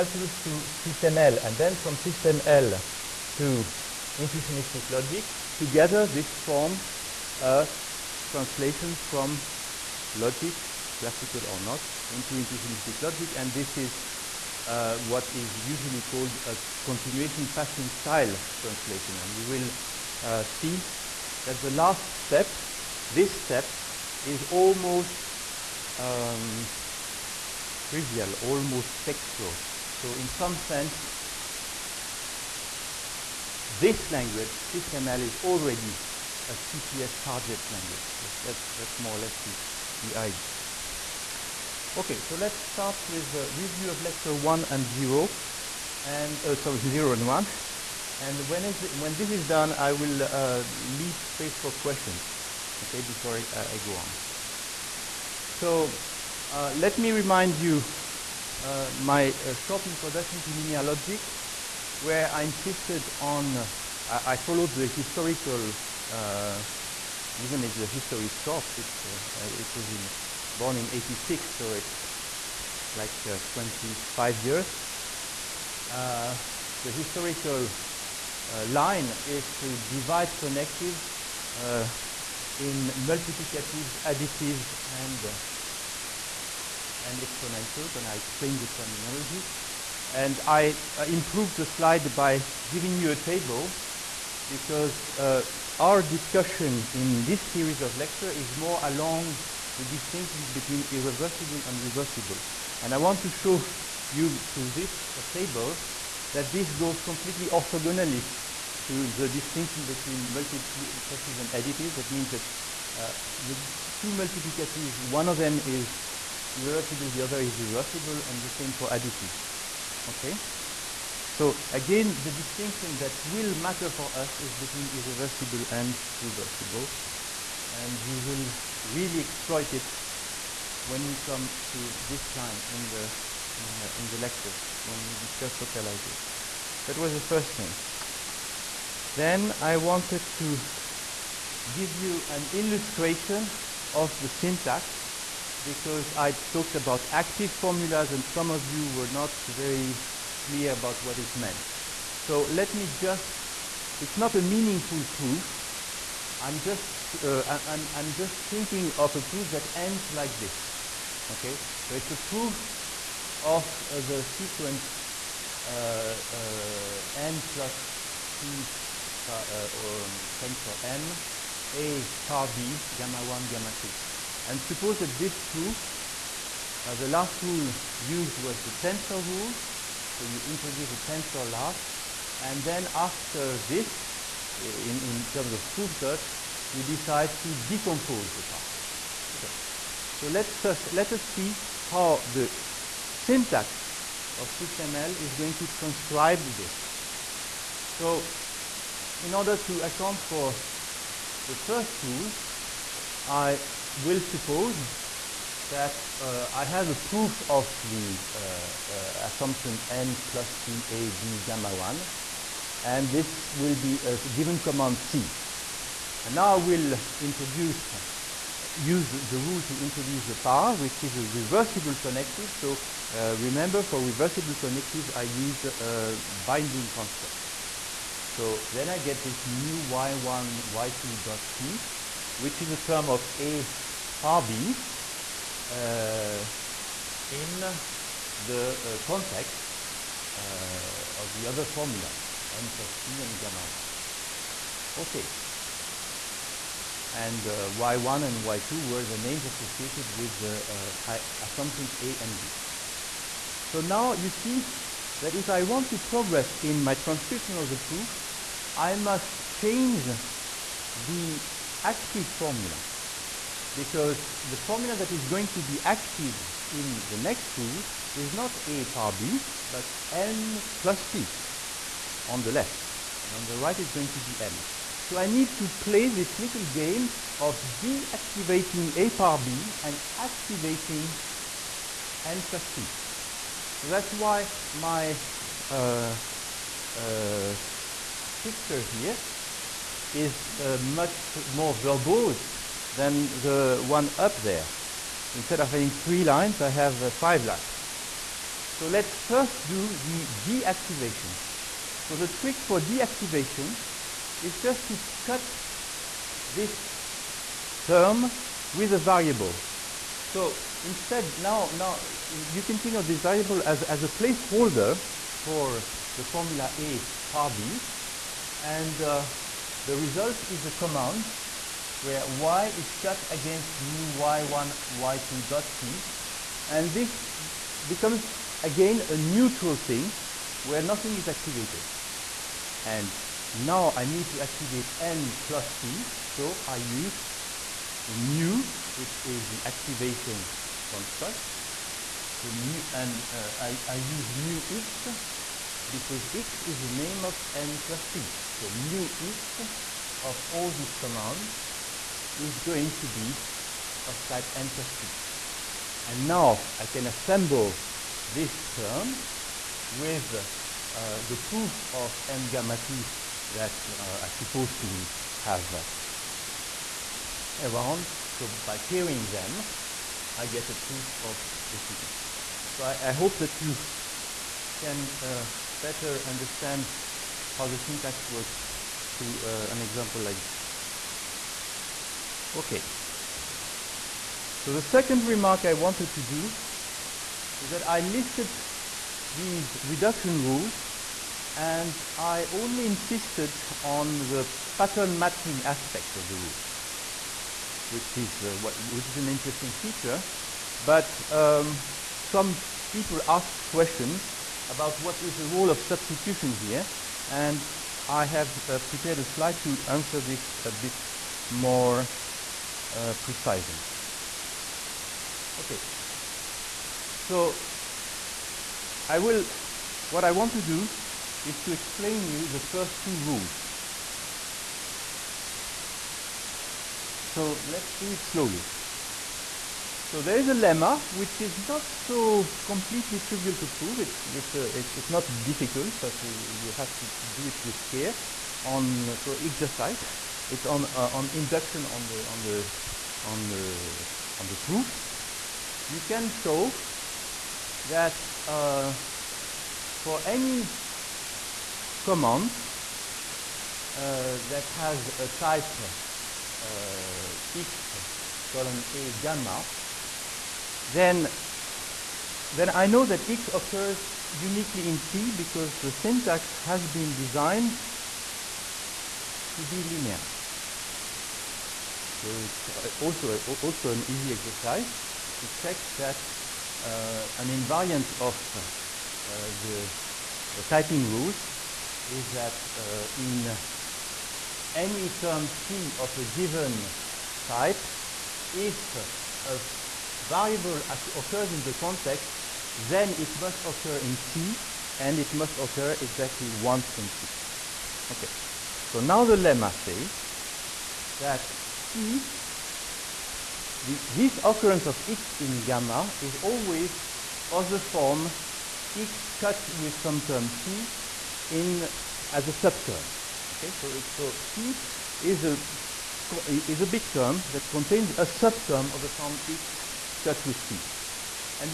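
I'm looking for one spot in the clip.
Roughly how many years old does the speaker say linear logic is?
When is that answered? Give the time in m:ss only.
1:13.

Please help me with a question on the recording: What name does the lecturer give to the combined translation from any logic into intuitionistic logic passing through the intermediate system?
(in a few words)
continuation passing style translation.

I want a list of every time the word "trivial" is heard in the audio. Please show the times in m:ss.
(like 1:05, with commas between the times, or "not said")
0:27, 7:13.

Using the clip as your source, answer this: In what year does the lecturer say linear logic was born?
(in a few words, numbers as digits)
1986.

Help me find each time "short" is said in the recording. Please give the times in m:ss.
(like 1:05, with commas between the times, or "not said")
0:59, 1:08.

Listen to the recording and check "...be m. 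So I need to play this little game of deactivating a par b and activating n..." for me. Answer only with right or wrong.
right.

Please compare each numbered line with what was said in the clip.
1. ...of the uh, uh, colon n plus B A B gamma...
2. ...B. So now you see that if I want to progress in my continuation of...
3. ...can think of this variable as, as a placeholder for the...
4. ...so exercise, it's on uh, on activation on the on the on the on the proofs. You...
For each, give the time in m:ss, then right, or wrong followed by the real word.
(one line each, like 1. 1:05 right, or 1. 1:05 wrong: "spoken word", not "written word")
1. 3:27 wrong: "assumption", not "colon"
2. 4:12 wrong: "transcription", not "continuation"
3. 5:12 right
4. 7:19 wrong: "induction", not "activation".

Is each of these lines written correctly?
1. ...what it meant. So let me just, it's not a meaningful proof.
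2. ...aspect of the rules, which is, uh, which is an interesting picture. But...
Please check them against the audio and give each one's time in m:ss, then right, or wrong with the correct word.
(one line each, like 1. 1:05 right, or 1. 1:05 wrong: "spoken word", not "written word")
1. 2:31 right
2. 6:35 wrong: "feature", not "picture".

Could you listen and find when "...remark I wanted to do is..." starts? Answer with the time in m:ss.
6:25.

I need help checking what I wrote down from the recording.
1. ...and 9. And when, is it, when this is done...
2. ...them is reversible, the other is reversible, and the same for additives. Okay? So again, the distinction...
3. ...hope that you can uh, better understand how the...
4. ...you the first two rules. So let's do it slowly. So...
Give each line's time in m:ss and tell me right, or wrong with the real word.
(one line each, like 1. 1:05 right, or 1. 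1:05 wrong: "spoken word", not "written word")
1. 0:47 wrong: "1", not "9"
2. 1:55 right
3. 6:13 right
4. 7:02 right.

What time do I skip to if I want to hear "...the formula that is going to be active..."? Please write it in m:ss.
4:24.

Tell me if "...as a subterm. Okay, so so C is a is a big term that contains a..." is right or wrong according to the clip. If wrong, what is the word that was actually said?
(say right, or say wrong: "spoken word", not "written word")
right.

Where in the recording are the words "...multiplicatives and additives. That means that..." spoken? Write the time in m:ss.
1:50.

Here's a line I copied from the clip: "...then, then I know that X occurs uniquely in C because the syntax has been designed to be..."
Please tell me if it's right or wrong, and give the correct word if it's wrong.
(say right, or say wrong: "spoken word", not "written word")
right.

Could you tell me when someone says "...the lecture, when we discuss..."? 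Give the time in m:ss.
2:14.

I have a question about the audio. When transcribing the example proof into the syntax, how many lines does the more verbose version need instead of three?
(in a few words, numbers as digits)
5.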